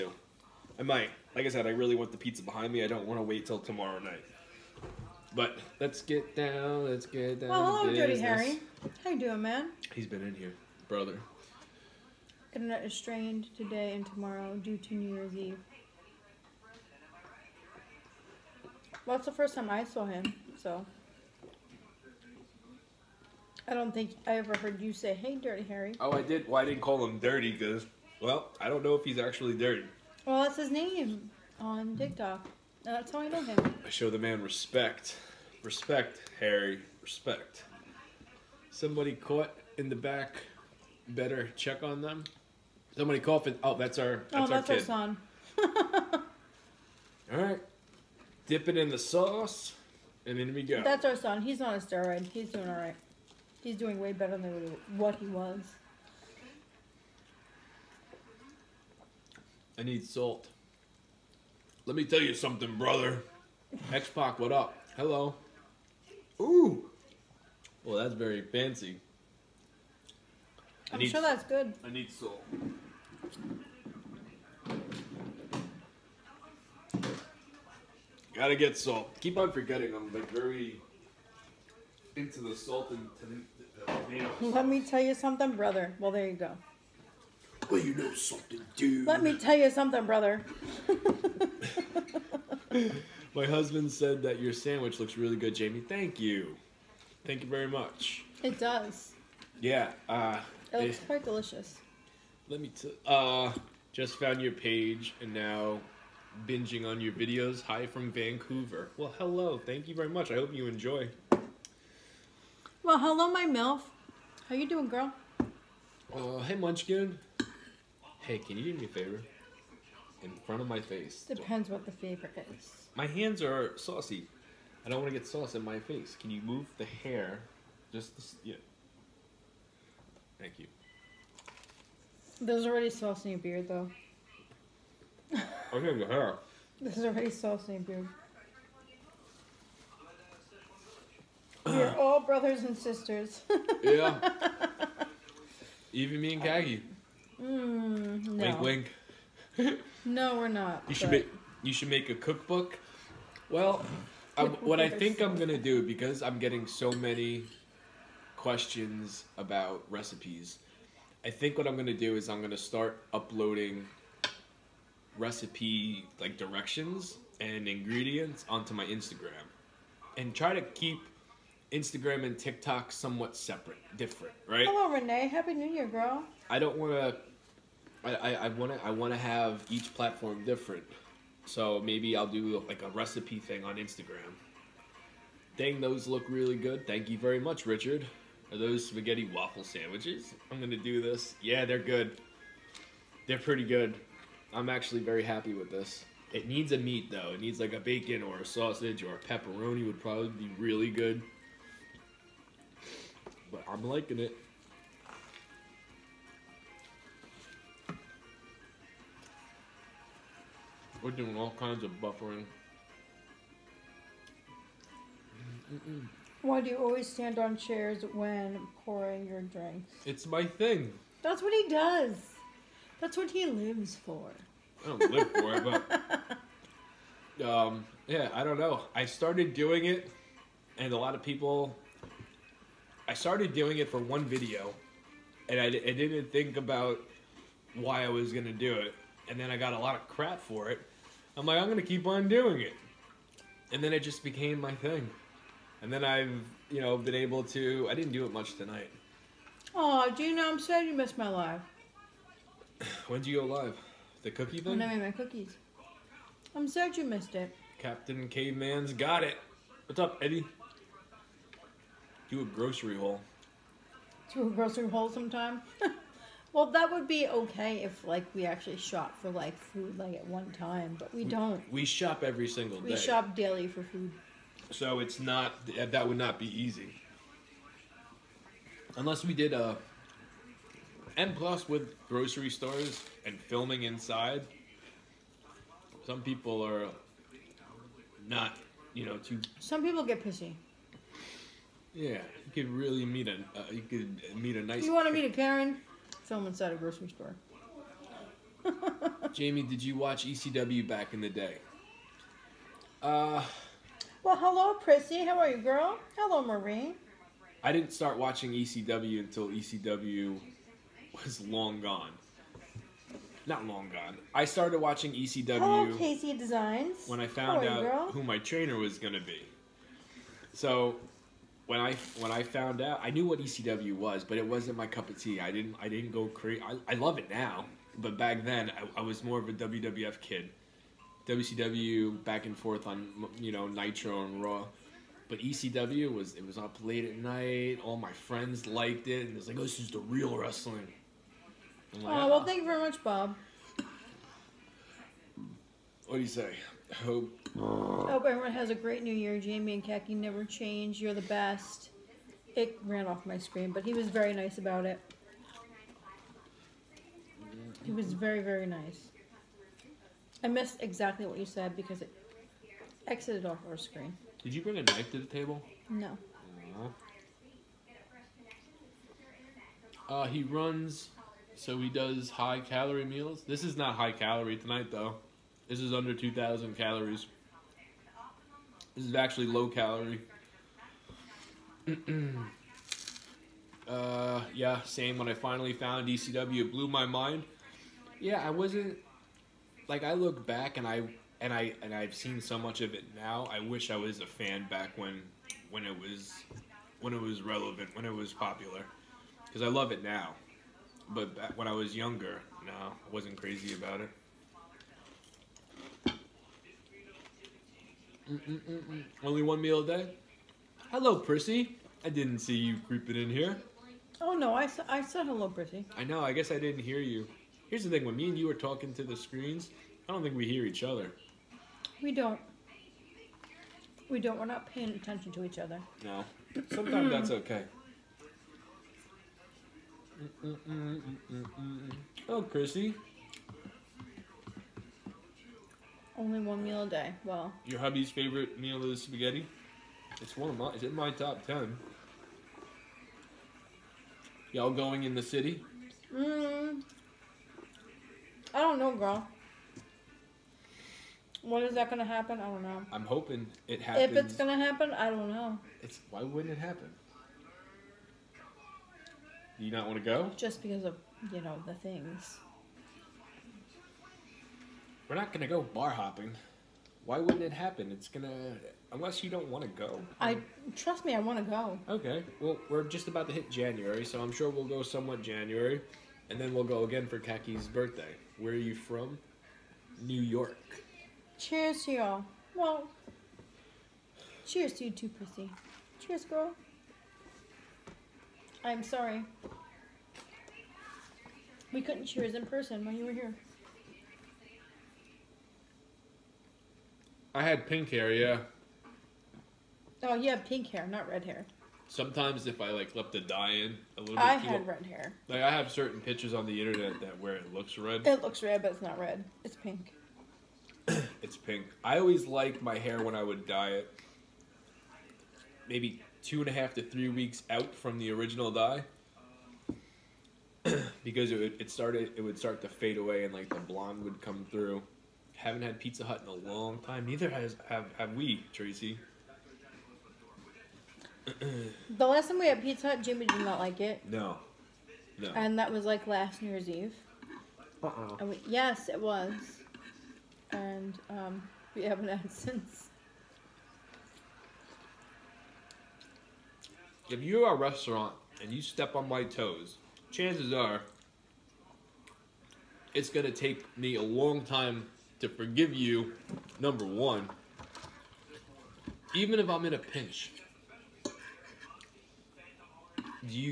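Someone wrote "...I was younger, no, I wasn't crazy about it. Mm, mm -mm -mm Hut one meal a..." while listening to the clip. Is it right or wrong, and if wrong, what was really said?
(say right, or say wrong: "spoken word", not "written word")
wrong: "Only", not "Hut".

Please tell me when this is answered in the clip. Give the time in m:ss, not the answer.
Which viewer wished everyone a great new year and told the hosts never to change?
5:43.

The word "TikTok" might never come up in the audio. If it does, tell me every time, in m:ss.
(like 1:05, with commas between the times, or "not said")
0:31, 2:52.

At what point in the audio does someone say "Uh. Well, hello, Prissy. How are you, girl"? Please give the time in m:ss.
5:03.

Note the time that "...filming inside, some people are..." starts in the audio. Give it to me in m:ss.
4:43.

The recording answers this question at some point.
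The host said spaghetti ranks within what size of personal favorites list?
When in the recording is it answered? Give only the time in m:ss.
7:21.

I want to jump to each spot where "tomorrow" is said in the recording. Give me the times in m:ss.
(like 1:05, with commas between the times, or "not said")
0:03, 0:14.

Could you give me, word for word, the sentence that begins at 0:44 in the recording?
That's oh, that's our, our son.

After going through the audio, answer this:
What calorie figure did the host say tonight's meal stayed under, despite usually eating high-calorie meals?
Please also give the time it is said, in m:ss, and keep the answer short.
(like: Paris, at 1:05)
2,000 calories, at 6:16.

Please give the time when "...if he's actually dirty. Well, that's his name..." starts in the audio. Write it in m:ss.
0:28.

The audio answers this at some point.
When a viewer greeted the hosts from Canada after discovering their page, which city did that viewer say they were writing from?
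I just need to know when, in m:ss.
1:48.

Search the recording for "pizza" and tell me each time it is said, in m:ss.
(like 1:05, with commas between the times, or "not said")
0:02, 8:45, 8:52.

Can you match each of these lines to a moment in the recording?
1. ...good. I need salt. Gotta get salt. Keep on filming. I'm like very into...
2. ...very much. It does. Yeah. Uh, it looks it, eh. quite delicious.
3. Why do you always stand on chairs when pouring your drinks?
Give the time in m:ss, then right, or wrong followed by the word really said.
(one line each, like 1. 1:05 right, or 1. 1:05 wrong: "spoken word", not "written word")
1. 1:11 wrong: "forgetting", not "filming"
2. 1:37 right
3. 3:36 right.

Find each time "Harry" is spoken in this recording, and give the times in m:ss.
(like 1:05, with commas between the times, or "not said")
0:08, 0:25, 0:36.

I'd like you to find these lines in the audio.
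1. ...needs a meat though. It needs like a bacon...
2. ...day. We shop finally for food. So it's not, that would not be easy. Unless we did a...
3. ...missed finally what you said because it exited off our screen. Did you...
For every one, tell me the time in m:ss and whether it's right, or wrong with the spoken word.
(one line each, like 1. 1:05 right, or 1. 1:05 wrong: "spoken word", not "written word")
1. 3:16 right
2. 4:32 wrong: "daily", not "finally"
3. 6:00 wrong: "exactly", not "finally".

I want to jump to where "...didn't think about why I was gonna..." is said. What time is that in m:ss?
3:55.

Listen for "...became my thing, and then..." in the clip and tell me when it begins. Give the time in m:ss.
4:04.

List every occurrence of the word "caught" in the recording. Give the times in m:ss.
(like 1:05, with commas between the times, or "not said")
0:39.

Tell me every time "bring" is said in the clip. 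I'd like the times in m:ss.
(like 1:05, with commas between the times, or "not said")
6:04.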